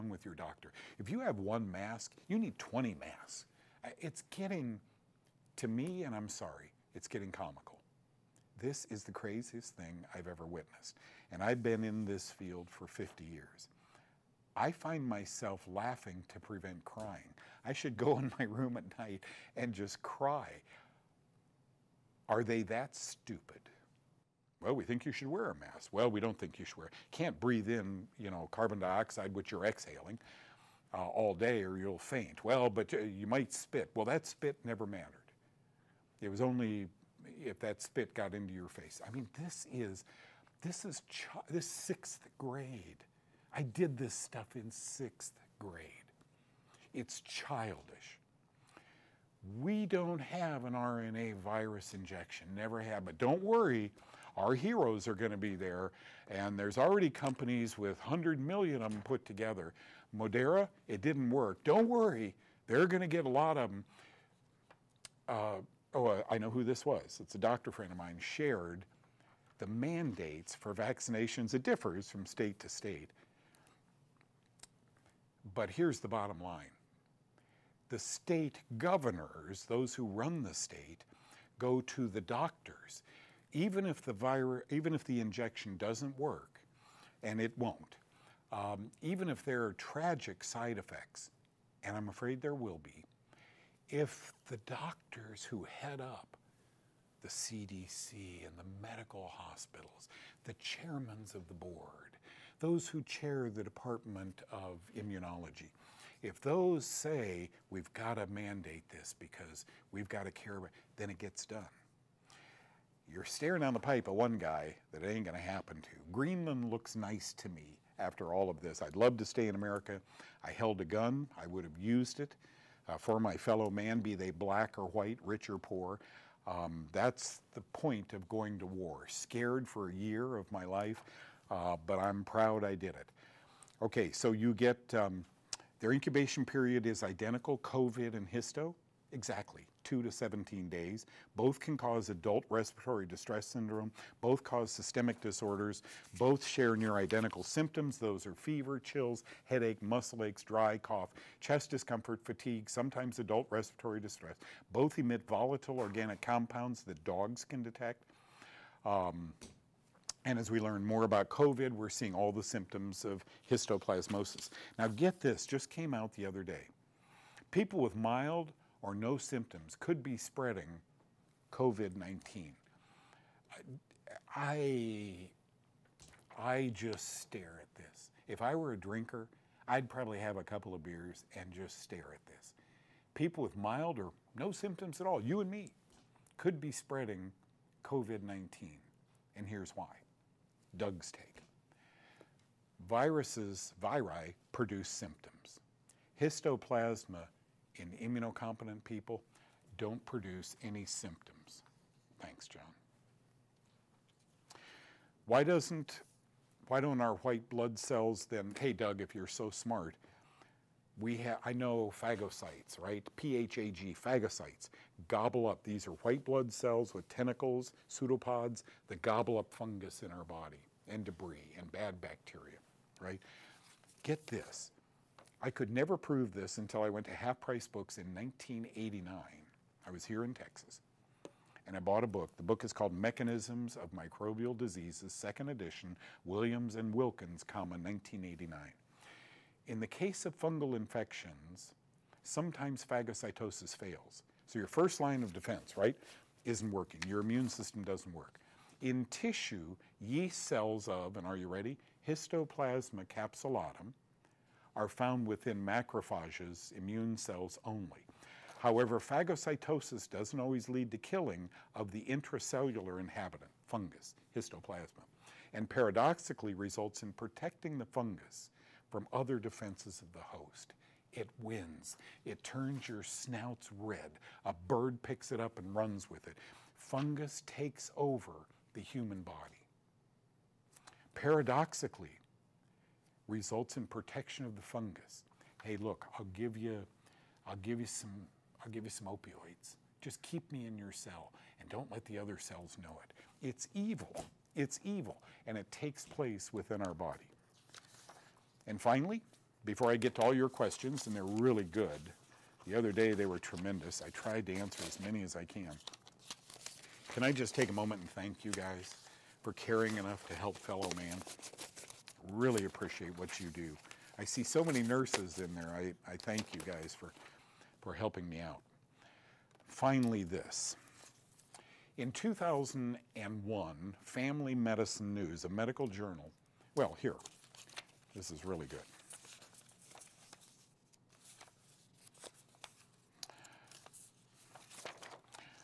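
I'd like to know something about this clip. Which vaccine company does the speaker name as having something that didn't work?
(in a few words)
Moderna.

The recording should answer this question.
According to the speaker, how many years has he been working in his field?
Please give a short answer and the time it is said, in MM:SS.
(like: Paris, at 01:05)
50 years, at 00:12.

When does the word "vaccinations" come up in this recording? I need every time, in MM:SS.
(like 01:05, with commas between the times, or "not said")
01:10.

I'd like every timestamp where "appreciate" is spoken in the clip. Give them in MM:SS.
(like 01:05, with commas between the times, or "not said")
05:12.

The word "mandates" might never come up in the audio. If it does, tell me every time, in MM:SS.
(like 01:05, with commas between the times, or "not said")
01:09, 01:48.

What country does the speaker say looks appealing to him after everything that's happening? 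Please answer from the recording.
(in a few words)
Greenland.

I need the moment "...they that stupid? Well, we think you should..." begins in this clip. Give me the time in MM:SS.
00:22.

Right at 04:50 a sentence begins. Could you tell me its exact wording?
Just keep me in your cell and don't let the other cells know it.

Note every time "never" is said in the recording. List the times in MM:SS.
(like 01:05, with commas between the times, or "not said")
00:34, 00:52, 03:45.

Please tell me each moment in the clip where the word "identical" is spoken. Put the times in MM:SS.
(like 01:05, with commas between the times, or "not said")
02:17, 02:26.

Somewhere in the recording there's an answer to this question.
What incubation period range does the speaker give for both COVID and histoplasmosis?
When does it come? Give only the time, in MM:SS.
02:19.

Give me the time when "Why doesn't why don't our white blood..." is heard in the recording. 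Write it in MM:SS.
03:25.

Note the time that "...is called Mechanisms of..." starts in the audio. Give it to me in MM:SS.
03:52.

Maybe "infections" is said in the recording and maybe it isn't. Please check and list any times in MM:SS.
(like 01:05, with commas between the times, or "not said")
04:00.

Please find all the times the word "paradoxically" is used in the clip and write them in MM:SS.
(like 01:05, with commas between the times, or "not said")
04:25, 04:41.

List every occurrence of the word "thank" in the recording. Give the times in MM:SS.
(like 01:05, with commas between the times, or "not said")
03:22, 05:08, 05:16.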